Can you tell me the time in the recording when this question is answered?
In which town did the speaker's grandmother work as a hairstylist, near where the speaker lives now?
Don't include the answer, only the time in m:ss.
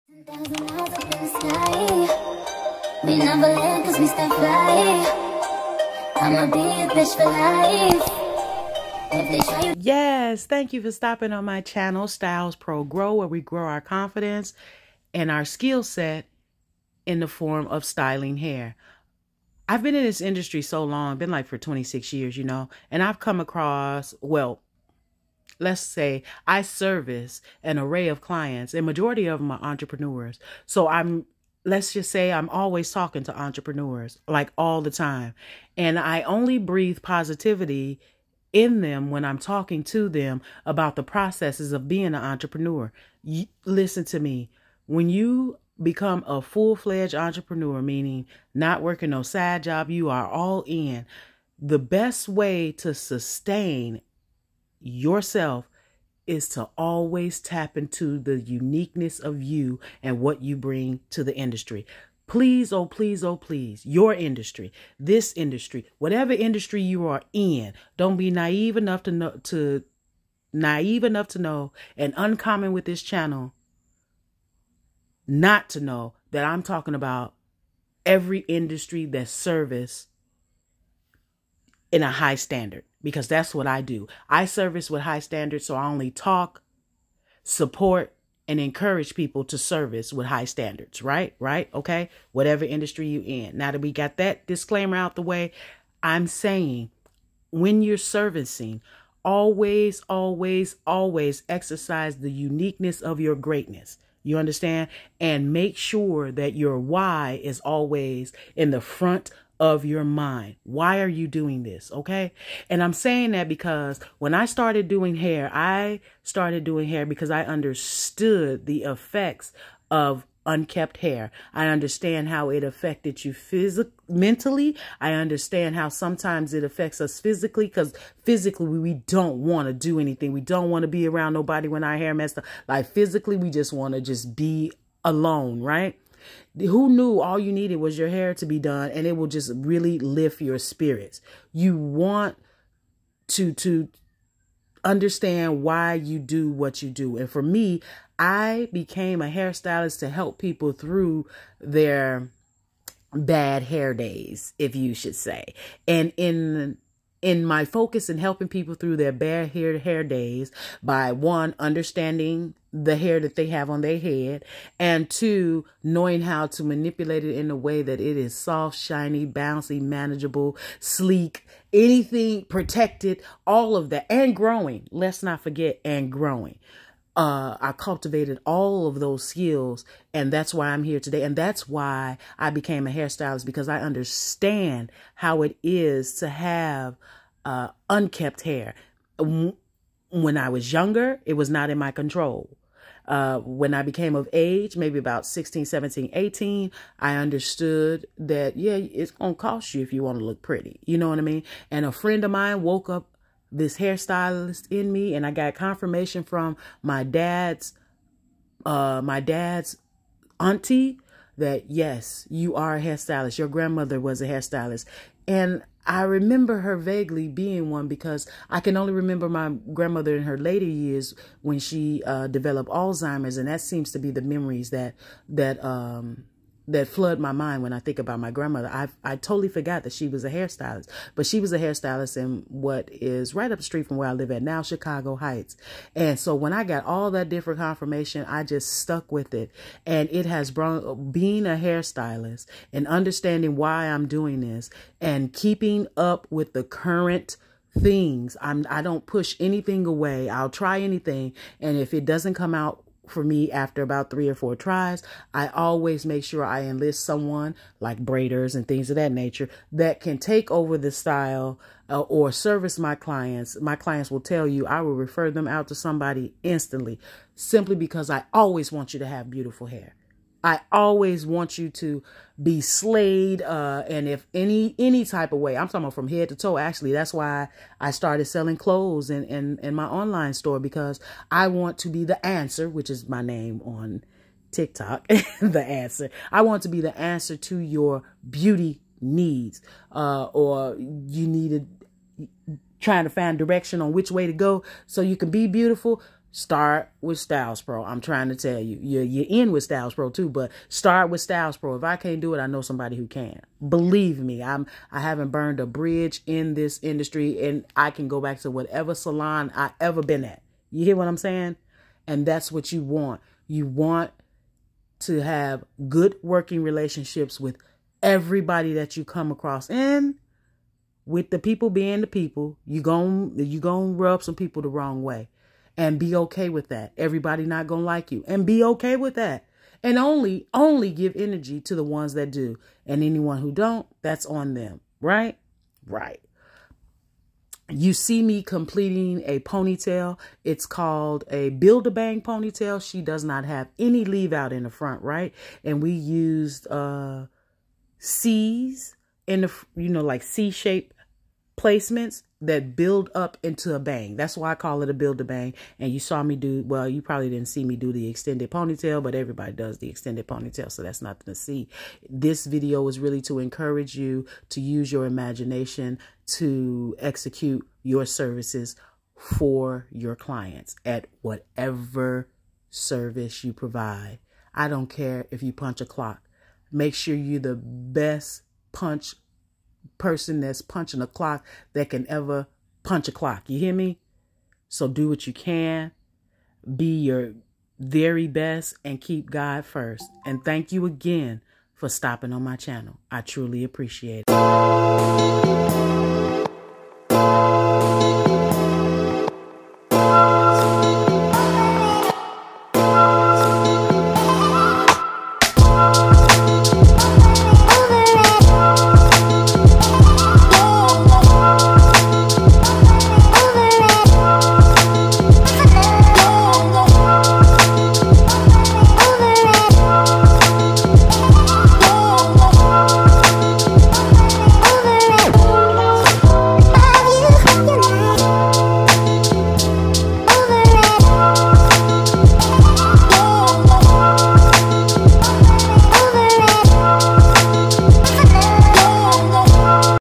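3:54.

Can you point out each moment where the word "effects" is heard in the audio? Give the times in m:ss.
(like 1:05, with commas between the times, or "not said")
1:58.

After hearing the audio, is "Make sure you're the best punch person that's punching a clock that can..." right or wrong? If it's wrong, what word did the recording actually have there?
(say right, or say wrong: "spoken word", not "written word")
right.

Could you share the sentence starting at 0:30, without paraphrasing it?
So I'm let's just say I'm always talking to entrepreneurs like all the time.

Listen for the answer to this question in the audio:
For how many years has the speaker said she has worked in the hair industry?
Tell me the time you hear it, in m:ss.
0:21.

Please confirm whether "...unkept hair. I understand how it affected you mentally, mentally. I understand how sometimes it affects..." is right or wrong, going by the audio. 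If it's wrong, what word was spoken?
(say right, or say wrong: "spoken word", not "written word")
wrong: "physically", not "mentally".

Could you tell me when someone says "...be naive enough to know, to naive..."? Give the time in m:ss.
1:08.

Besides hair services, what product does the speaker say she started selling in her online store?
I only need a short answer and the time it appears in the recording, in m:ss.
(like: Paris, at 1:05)
Clothes, at 4:38.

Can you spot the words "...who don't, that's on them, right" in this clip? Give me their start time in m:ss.
5:33.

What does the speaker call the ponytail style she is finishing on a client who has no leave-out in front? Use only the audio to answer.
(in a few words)
Build a bang ponytail.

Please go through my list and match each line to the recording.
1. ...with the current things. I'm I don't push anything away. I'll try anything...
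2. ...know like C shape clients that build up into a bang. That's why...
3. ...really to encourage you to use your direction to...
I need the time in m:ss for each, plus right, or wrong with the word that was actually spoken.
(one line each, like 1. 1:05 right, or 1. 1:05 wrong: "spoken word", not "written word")
1. 4:06 right
2. 5:49 wrong: "placements", not "clients"
3. 6:02 wrong: "imagination", not "direction".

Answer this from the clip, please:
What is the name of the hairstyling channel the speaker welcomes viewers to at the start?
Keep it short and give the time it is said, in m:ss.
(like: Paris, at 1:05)
Styles Pro Grow, at 0:12.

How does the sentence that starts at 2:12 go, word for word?
Like physically, we just want to just be alone, right?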